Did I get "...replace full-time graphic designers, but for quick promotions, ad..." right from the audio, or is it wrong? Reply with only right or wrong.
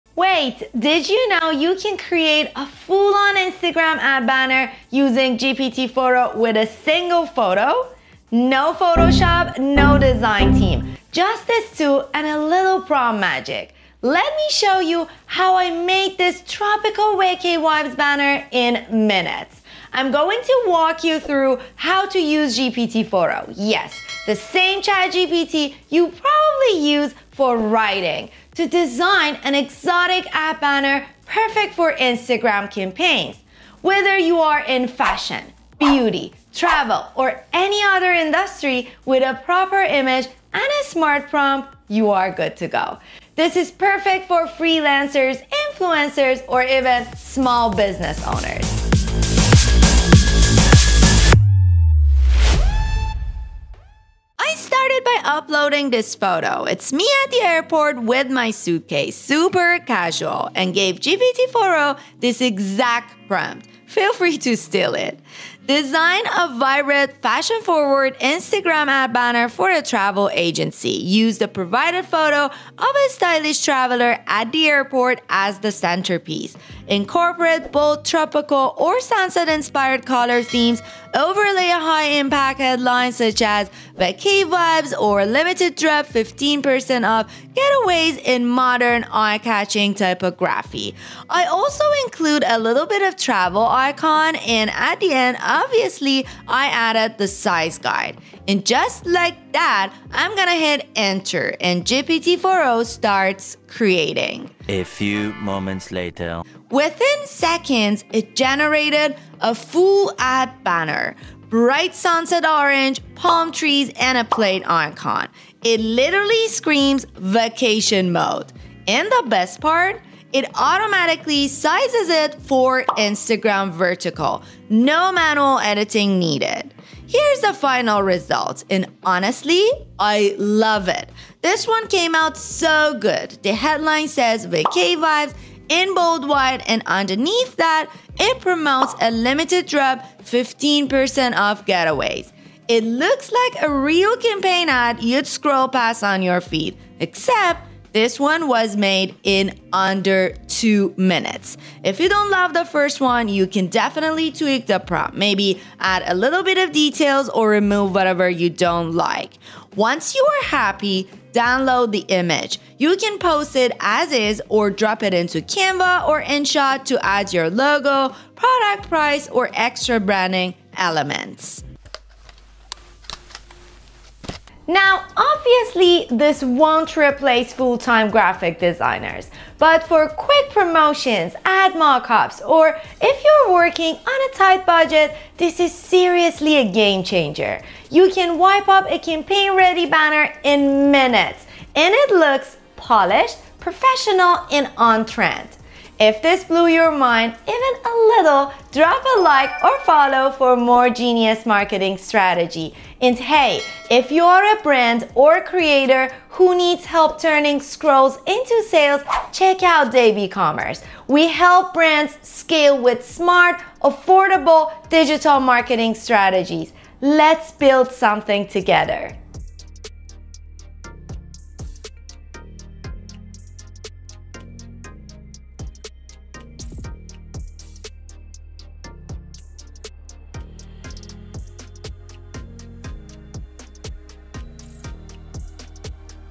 right.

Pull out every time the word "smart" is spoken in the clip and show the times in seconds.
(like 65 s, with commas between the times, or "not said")
40 s, 213 s.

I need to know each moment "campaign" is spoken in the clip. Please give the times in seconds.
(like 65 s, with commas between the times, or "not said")
32 s, 144 s, 188 s.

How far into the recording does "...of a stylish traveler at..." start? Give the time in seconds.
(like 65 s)
72 s.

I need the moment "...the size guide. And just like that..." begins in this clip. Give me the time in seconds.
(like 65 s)
97 s.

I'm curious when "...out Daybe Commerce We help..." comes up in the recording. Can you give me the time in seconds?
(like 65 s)
209 s.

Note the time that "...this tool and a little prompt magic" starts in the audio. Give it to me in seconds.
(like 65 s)
11 s.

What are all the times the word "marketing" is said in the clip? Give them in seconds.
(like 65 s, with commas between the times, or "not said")
201 s, 215 s.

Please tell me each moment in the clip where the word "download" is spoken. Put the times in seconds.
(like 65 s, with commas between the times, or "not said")
161 s.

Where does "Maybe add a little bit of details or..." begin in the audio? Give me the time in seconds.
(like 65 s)
155 s.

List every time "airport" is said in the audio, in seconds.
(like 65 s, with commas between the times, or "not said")
57 s, 74 s.